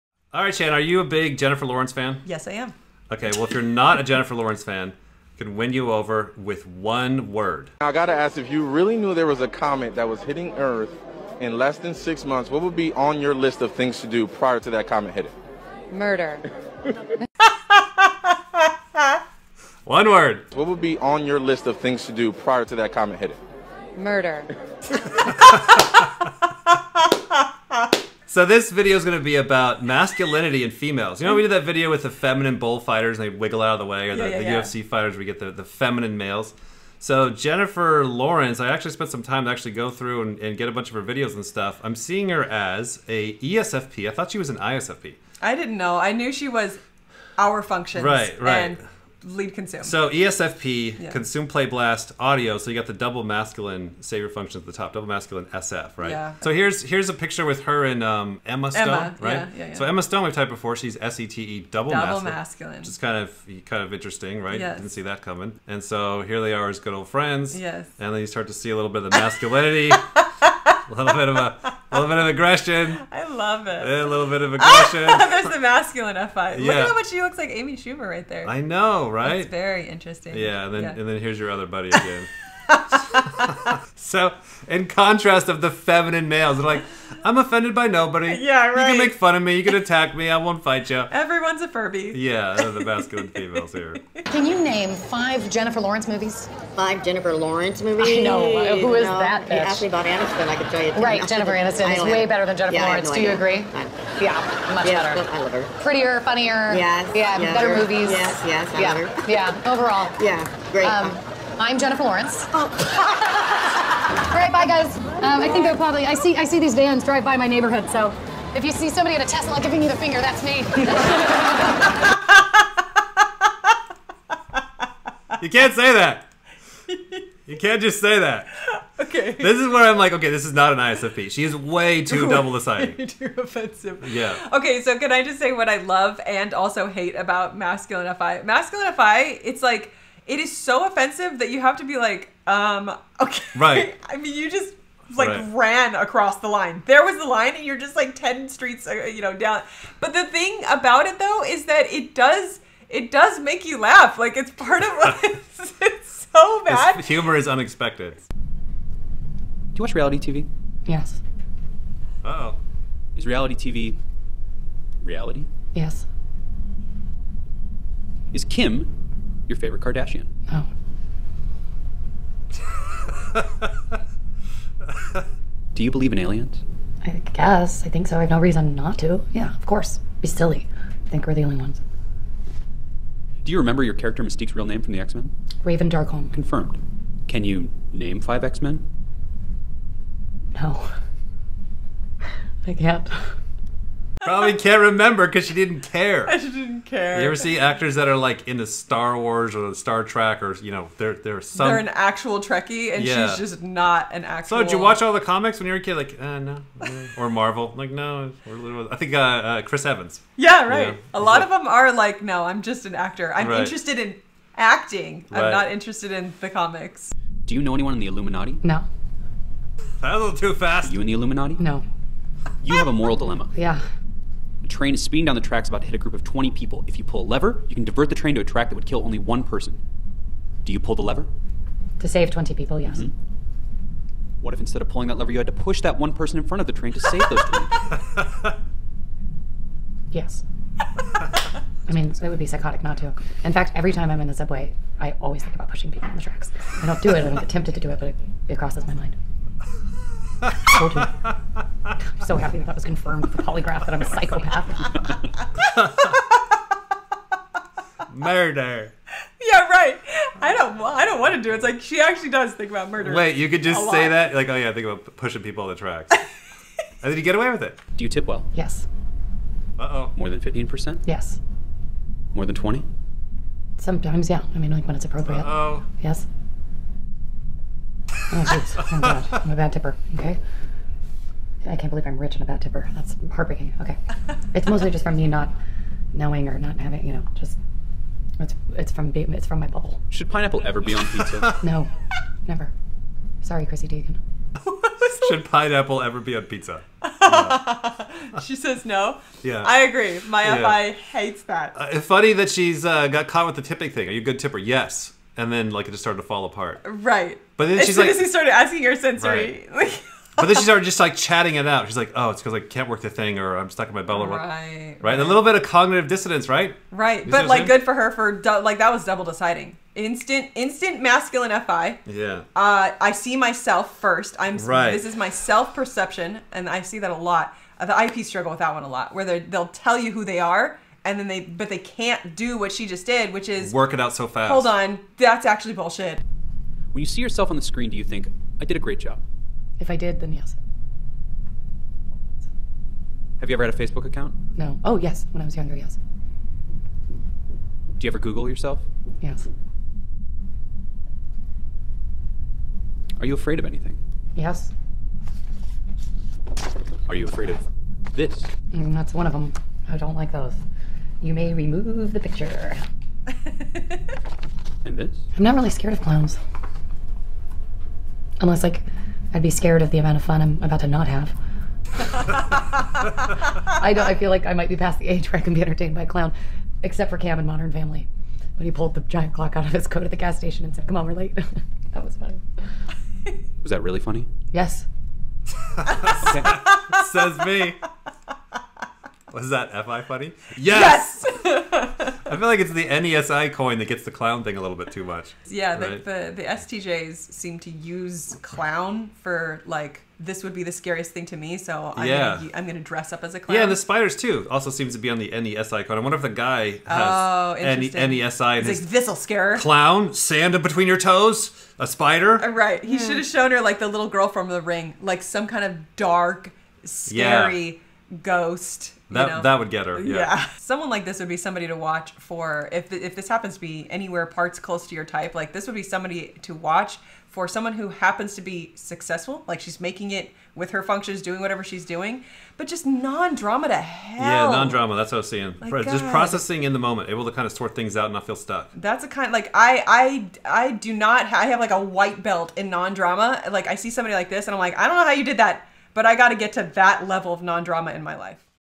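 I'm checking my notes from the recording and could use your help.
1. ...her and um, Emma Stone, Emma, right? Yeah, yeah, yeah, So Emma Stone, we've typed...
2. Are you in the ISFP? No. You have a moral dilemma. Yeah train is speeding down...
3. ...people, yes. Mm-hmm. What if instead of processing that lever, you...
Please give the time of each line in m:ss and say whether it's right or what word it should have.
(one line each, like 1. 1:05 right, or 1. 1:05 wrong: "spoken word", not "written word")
1. 0:57 right
2. 3:40 wrong: "Illuminati", not "ISFP"
3. 3:52 wrong: "pulling", not "processing".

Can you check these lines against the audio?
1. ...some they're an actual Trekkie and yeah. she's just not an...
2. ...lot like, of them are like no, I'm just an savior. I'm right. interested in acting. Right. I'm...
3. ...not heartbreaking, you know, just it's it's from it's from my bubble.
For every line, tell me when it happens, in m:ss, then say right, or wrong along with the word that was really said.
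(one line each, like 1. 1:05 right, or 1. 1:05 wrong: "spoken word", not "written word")
1. 3:21 right
2. 3:31 wrong: "actor", not "savior"
3. 4:46 wrong: "having", not "heartbreaking".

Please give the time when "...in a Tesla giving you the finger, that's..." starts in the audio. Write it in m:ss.
1:59.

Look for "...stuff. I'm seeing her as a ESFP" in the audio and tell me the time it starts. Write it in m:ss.
0:41.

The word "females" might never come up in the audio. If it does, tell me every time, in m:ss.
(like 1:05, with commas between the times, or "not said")
0:30, 1:33.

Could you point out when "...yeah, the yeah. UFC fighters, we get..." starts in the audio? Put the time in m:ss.
0:34.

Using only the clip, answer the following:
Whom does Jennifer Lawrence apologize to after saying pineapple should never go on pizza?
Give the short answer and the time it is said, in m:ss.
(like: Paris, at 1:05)
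Chrissy Teigen, at 4:53.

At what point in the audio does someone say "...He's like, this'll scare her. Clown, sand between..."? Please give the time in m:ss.
6:48.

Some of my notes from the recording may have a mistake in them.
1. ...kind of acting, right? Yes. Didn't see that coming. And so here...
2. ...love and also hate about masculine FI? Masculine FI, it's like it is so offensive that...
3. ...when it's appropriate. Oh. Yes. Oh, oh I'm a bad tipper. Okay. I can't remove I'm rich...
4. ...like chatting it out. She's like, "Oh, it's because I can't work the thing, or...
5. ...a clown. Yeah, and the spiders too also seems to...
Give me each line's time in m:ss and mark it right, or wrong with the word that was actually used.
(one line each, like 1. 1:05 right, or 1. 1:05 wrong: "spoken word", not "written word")
1. 1:03 wrong: "interesting", not "acting"
2. 2:15 right
3. 4:34 wrong: "believe", not "remove"
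4. 5:10 right
5. 6:43 right.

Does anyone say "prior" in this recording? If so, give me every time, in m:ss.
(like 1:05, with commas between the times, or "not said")
0:14, 0:22.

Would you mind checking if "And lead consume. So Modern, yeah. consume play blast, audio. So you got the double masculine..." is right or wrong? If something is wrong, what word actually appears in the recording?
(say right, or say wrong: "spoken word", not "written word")
wrong: "ESFP", not "Modern".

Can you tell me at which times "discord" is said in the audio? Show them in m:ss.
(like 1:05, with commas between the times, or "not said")
not said.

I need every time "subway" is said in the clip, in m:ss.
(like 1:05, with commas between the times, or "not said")
4:04.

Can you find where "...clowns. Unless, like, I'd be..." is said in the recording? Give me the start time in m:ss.
6:06.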